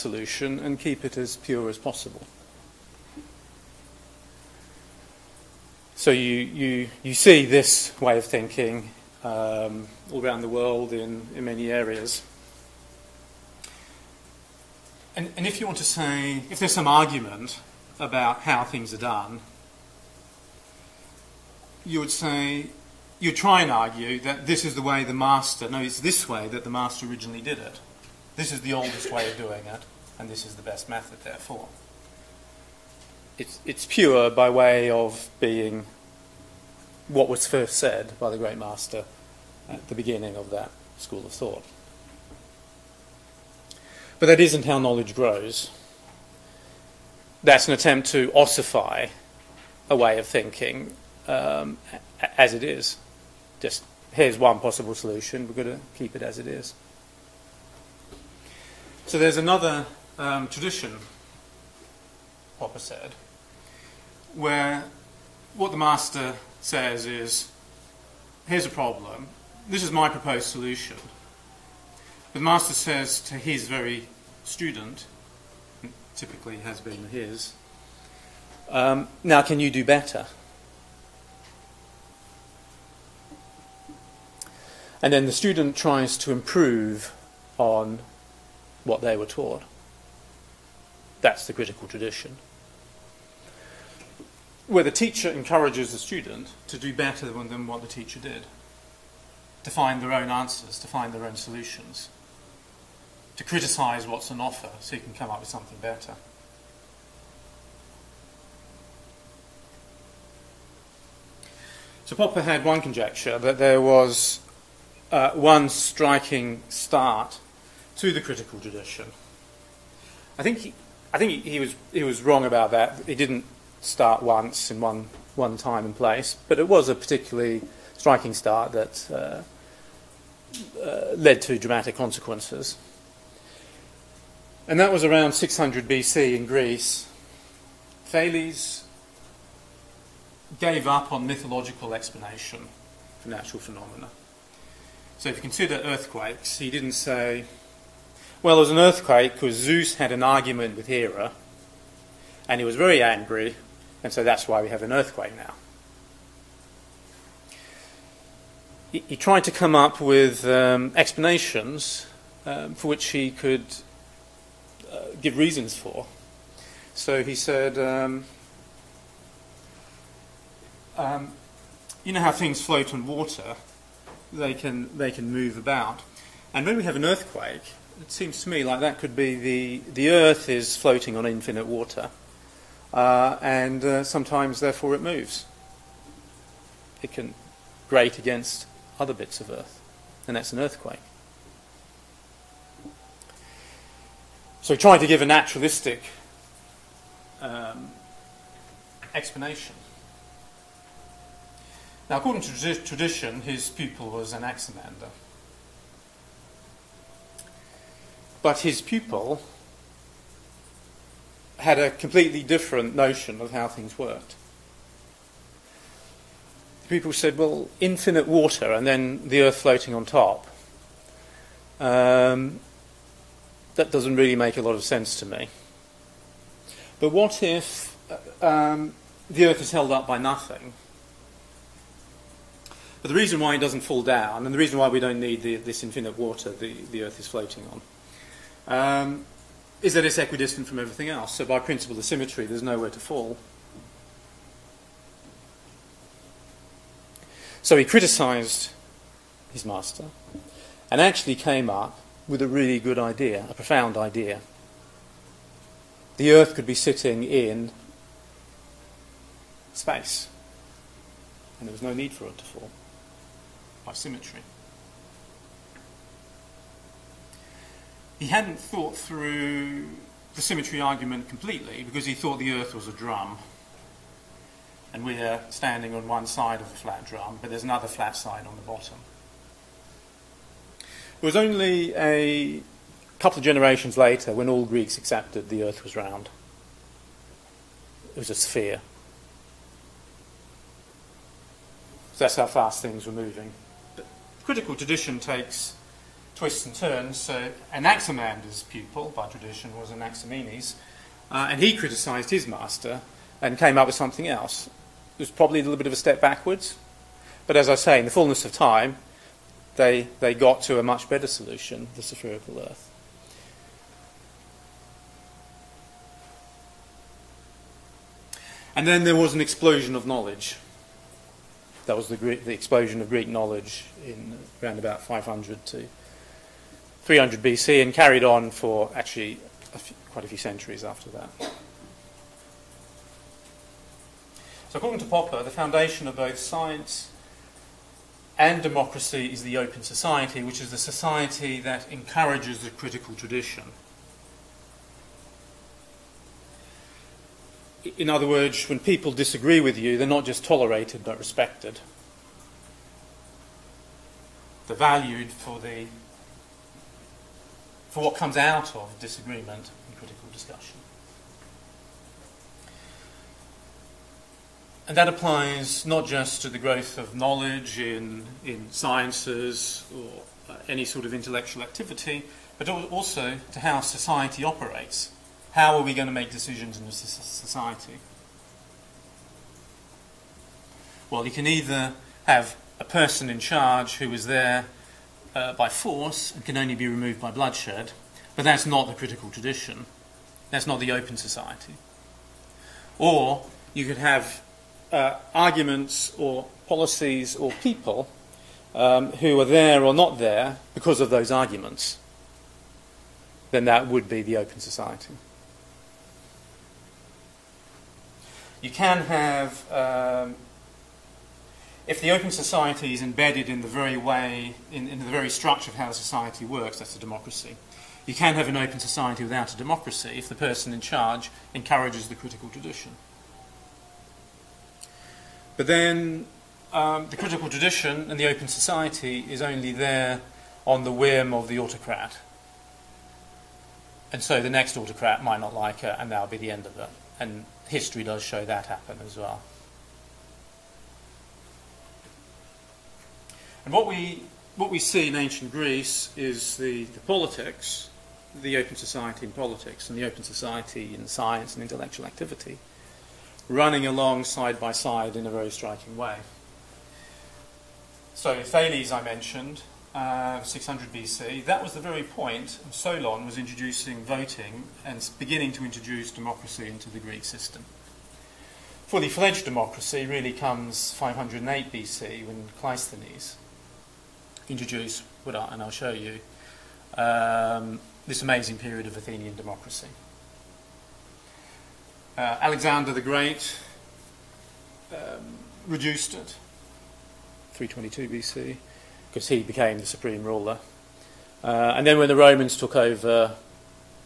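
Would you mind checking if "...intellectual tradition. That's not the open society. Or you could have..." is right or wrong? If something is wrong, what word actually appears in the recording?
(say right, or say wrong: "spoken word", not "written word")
wrong: "critical", not "intellectual".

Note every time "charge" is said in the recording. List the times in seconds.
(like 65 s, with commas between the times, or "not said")
383 s, 420 s.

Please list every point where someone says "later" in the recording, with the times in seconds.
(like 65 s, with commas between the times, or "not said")
283 s.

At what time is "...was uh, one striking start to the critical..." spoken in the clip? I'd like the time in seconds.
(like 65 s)
113 s.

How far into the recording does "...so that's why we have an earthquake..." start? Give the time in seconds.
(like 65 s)
154 s.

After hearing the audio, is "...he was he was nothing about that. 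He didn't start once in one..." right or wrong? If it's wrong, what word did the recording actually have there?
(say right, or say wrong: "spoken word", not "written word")
wrong: "wrong", not "nothing".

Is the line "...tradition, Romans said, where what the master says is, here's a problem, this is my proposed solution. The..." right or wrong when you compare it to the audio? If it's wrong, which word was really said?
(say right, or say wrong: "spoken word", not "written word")
wrong: "Popper", not "Romans".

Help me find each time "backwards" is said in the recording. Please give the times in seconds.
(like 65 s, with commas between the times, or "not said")
306 s.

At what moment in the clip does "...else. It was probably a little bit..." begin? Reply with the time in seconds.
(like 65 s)
304 s.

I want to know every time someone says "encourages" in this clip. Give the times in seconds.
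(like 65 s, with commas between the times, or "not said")
95 s, 341 s, 421 s.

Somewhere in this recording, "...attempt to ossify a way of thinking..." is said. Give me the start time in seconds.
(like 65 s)
47 s.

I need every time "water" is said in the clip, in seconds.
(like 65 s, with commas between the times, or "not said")
173 s, 181 s, 218 s, 236 s.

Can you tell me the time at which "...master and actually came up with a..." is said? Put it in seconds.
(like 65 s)
249 s.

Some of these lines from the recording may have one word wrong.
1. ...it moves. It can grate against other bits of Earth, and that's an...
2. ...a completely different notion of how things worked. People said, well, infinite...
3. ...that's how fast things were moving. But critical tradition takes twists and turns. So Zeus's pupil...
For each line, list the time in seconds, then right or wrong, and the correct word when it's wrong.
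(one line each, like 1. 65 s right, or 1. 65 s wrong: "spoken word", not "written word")
1. 184 s right
2. 211 s right
3. 292 s wrong: "Anaximander", not "Zeus".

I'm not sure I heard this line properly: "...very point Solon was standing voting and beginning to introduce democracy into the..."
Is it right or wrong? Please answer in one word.
wrong.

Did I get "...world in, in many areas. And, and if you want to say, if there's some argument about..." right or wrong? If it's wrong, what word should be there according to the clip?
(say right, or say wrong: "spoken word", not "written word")
right.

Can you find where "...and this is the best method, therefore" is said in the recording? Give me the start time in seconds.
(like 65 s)
30 s.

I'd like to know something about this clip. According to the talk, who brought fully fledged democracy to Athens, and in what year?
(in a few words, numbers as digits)
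Cleisthenes, 508 BC.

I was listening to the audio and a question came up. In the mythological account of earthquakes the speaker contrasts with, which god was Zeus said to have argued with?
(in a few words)
Hera.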